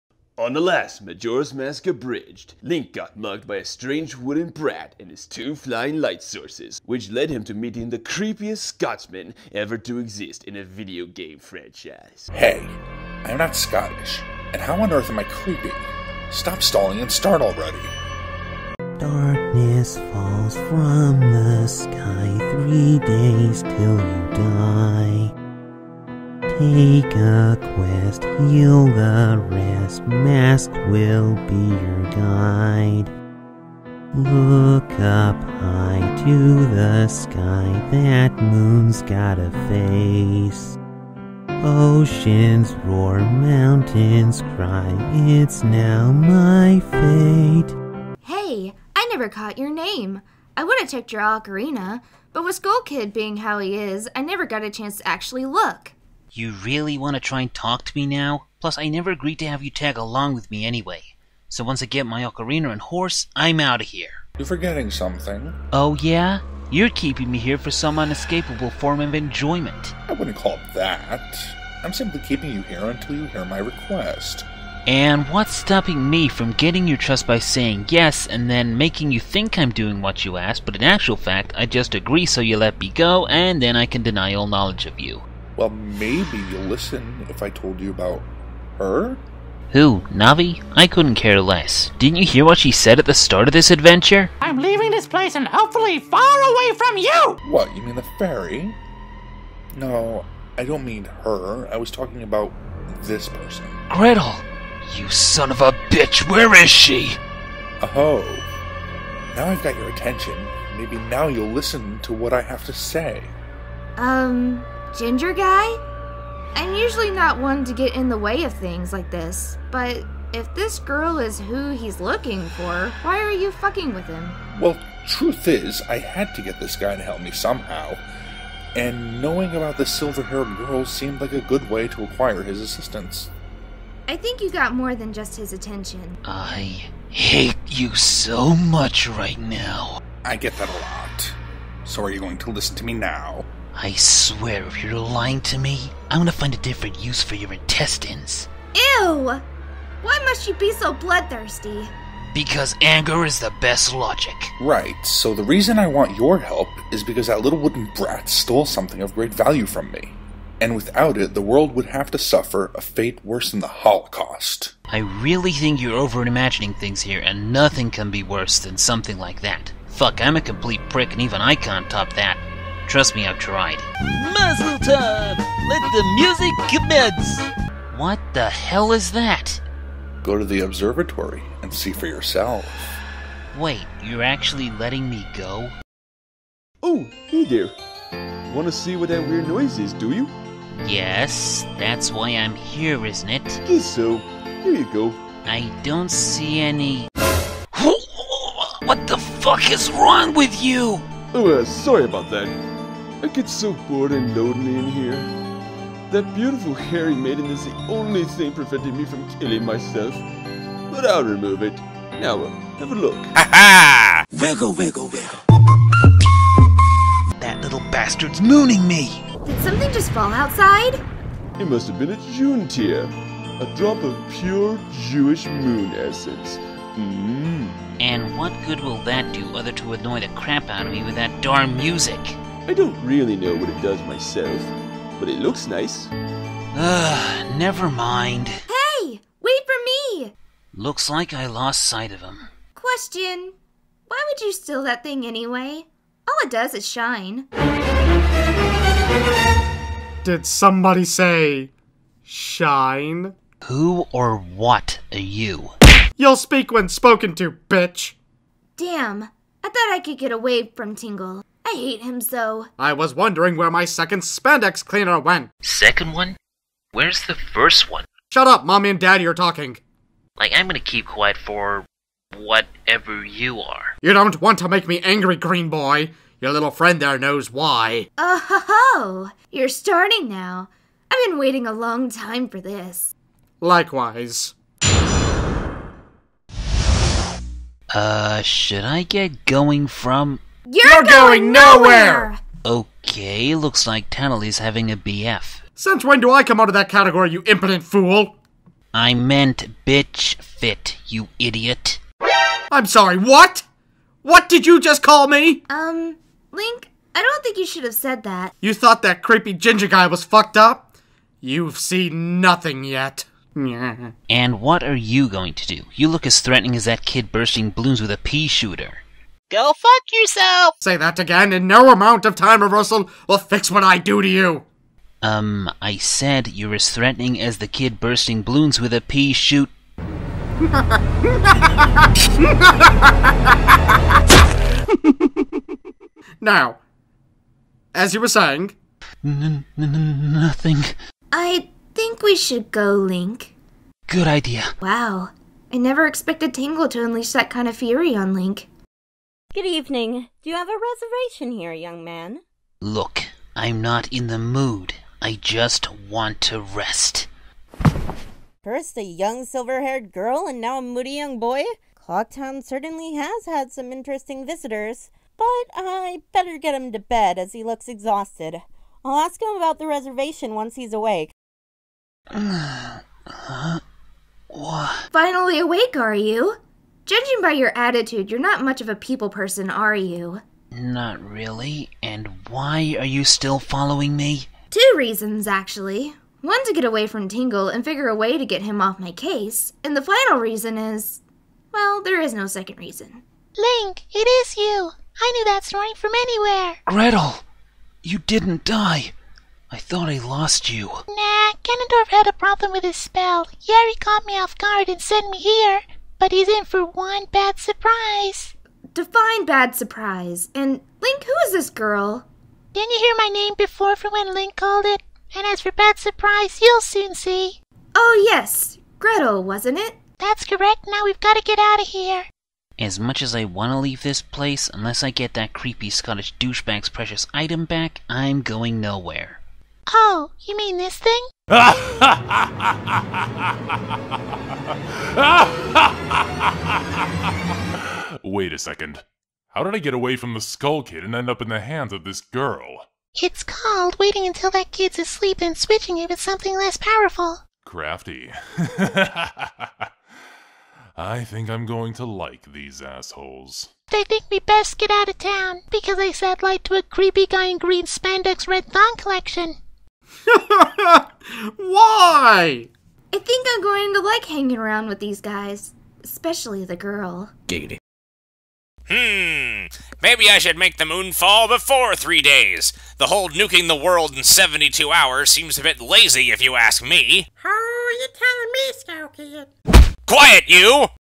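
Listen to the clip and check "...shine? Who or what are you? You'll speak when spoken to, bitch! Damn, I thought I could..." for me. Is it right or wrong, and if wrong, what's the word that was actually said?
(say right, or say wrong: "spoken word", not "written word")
right.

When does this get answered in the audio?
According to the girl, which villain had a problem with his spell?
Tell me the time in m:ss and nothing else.
6:41.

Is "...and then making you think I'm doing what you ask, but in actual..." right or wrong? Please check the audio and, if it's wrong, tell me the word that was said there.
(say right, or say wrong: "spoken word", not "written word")
right.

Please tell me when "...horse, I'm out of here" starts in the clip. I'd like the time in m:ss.
1:02.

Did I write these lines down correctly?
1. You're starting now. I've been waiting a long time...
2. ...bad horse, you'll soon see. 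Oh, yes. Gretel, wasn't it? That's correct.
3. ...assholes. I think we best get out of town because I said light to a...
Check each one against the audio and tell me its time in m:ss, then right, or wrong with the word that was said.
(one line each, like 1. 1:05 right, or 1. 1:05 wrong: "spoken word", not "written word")
1. 4:39 right
2. 6:55 wrong: "surprise", not "horse"
3. 7:32 right.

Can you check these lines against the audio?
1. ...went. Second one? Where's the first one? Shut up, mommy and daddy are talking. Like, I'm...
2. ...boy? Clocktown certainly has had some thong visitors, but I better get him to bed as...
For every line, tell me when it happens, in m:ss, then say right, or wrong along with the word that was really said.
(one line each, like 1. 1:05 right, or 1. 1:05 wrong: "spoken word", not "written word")
1. 4:25 right
2. 6:01 wrong: "interesting", not "thong".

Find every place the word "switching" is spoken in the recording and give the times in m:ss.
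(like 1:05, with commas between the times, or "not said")
7:25.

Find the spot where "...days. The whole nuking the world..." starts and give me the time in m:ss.
7:52.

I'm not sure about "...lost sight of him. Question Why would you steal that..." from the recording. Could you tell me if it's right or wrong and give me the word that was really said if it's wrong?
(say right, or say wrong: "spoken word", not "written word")
right.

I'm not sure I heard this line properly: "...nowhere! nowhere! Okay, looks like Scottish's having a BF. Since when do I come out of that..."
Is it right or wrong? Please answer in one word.
wrong.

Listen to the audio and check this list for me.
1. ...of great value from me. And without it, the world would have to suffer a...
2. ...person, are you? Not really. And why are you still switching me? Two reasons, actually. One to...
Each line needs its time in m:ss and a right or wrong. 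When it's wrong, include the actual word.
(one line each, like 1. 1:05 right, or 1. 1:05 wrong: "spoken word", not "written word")
1. 2:39 right
2. 6:19 wrong: "following", not "switching".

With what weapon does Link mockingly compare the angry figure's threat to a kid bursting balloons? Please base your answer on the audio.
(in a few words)
A pea shooter.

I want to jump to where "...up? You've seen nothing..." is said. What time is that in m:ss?
5:10.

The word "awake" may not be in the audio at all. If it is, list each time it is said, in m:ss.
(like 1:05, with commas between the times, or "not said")
6:10, 6:15.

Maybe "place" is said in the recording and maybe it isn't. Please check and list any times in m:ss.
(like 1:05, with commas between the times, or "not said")
1:35, 7:04.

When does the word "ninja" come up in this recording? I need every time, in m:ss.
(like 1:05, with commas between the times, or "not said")
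not said.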